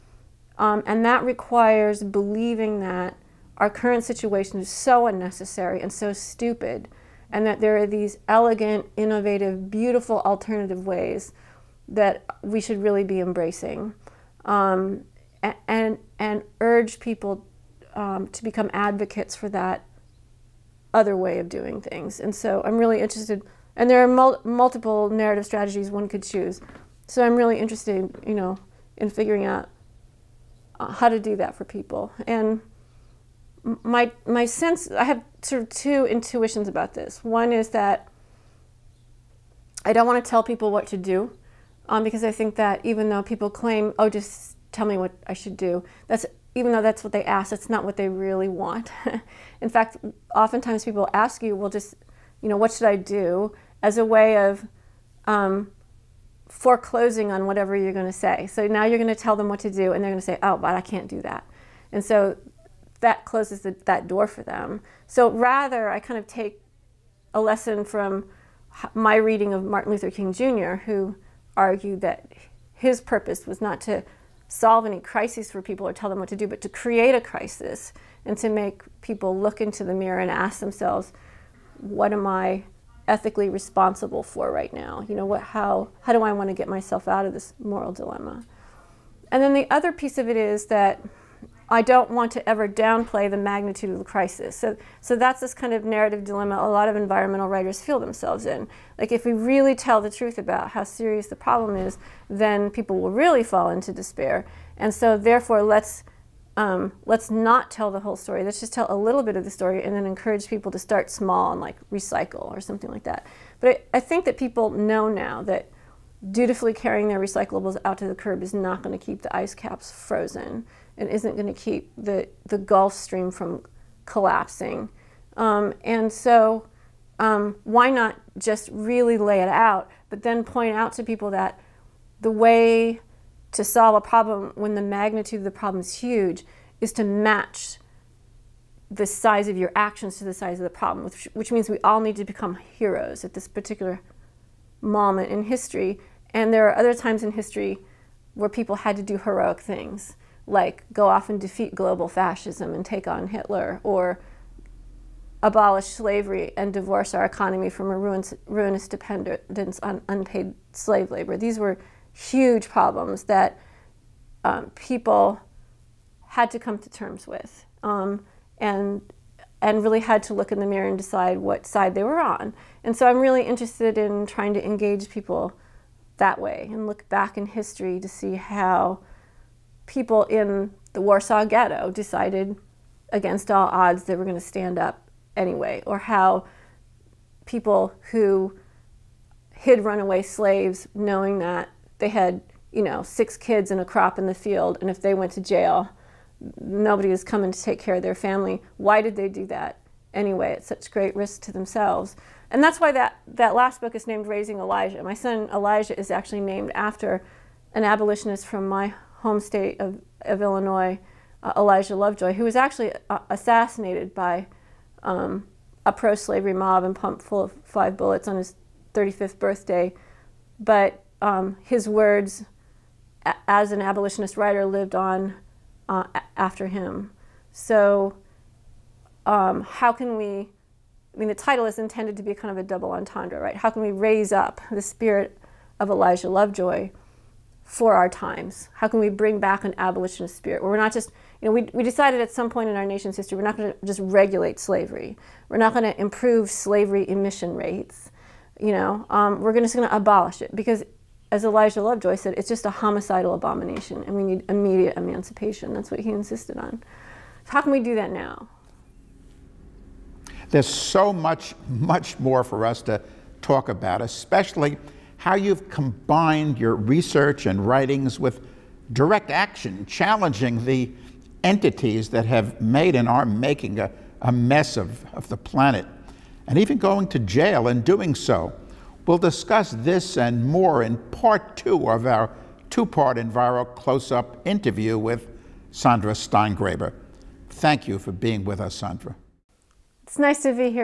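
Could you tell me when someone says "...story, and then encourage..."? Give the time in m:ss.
1:49.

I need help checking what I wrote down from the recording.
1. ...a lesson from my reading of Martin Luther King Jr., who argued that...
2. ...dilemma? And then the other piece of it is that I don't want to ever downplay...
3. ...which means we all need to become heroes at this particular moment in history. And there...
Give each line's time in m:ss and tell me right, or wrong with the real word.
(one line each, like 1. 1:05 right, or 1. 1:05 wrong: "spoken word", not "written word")
1. 1:07 right
2. 1:27 right
3. 2:21 right.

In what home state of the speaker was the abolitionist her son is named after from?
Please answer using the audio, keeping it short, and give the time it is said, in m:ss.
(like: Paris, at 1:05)
Illinois, at 3:30.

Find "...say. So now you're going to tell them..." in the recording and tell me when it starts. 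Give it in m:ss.
0:58.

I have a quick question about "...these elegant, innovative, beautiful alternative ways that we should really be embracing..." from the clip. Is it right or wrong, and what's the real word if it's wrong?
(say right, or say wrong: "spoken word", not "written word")
right.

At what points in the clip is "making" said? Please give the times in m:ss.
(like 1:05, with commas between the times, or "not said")
4:33.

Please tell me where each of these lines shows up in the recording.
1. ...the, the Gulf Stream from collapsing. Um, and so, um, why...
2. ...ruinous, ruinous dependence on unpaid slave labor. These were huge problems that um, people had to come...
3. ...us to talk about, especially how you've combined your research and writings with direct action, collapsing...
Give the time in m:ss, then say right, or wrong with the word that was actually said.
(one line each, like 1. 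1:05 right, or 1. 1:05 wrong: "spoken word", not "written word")
1. 2:01 right
2. 2:37 right
3. 4:22 wrong: "challenging", not "collapsing".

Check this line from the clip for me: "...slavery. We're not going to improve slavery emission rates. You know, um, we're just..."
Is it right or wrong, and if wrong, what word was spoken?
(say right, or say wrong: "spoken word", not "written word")
right.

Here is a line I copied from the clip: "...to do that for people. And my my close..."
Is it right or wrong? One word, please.
wrong.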